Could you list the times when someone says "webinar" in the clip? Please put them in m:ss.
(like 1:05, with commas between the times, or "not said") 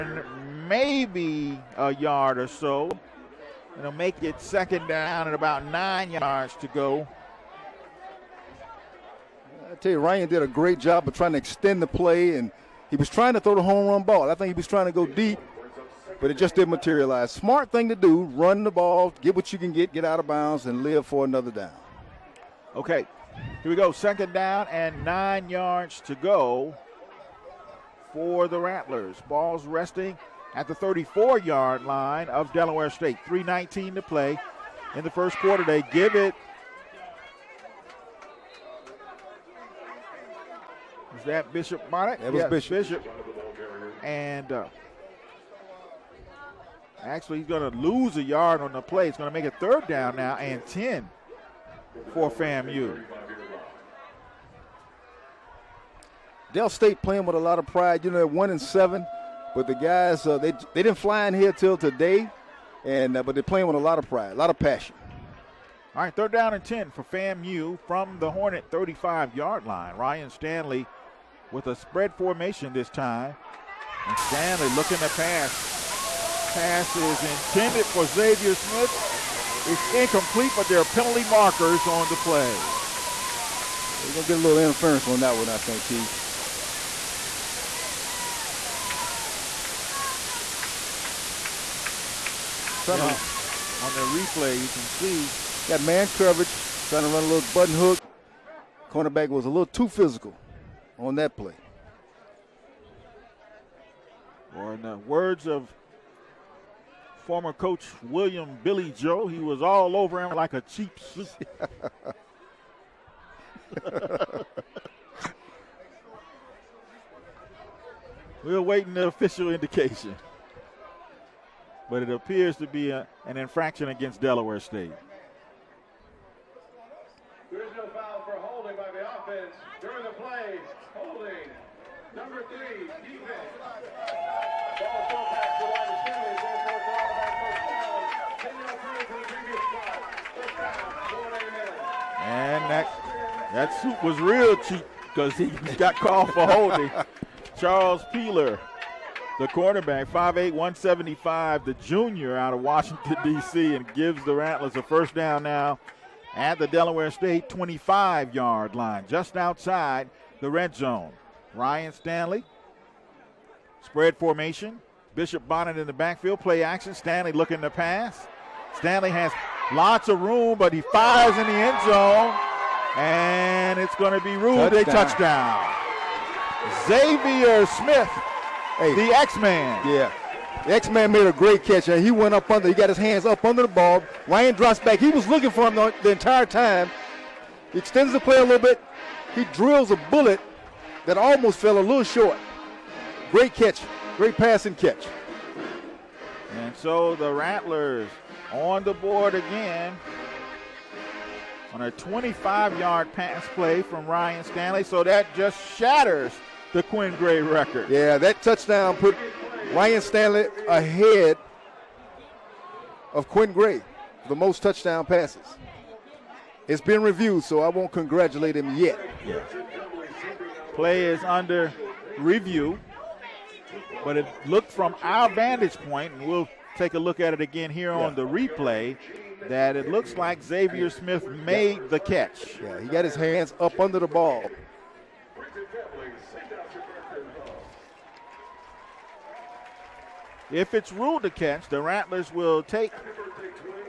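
not said.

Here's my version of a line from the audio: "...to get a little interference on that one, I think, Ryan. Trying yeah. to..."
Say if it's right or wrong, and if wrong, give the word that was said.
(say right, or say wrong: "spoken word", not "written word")
wrong: "Keith", not "Ryan".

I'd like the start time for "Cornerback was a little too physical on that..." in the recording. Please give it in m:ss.
1:38.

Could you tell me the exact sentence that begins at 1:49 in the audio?
He was all over him like a cheap suit.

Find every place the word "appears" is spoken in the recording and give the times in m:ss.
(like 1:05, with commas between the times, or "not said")
2:02.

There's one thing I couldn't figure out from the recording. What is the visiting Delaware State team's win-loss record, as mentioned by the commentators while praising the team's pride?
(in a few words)
1 and 7.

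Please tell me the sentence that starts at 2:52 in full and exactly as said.
And it's going to be ruled touchdown.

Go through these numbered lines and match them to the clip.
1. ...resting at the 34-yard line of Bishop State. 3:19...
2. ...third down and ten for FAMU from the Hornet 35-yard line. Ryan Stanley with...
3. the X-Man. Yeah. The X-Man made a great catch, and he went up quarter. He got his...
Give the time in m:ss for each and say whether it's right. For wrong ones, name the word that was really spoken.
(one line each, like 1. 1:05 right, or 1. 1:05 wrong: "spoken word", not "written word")
1. 0:29 wrong: "Delaware", not "Bishop"
2. 1:06 right
3. 2:58 wrong: "under", not "quarter".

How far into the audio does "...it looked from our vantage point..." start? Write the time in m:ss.
3:44.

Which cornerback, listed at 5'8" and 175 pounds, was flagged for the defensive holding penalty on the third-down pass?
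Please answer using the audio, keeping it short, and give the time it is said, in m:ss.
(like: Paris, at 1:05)
Charles Peeler, at 2:27.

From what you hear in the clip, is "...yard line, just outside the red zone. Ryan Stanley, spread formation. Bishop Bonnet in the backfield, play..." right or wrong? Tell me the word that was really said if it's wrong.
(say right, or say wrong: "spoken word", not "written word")
right.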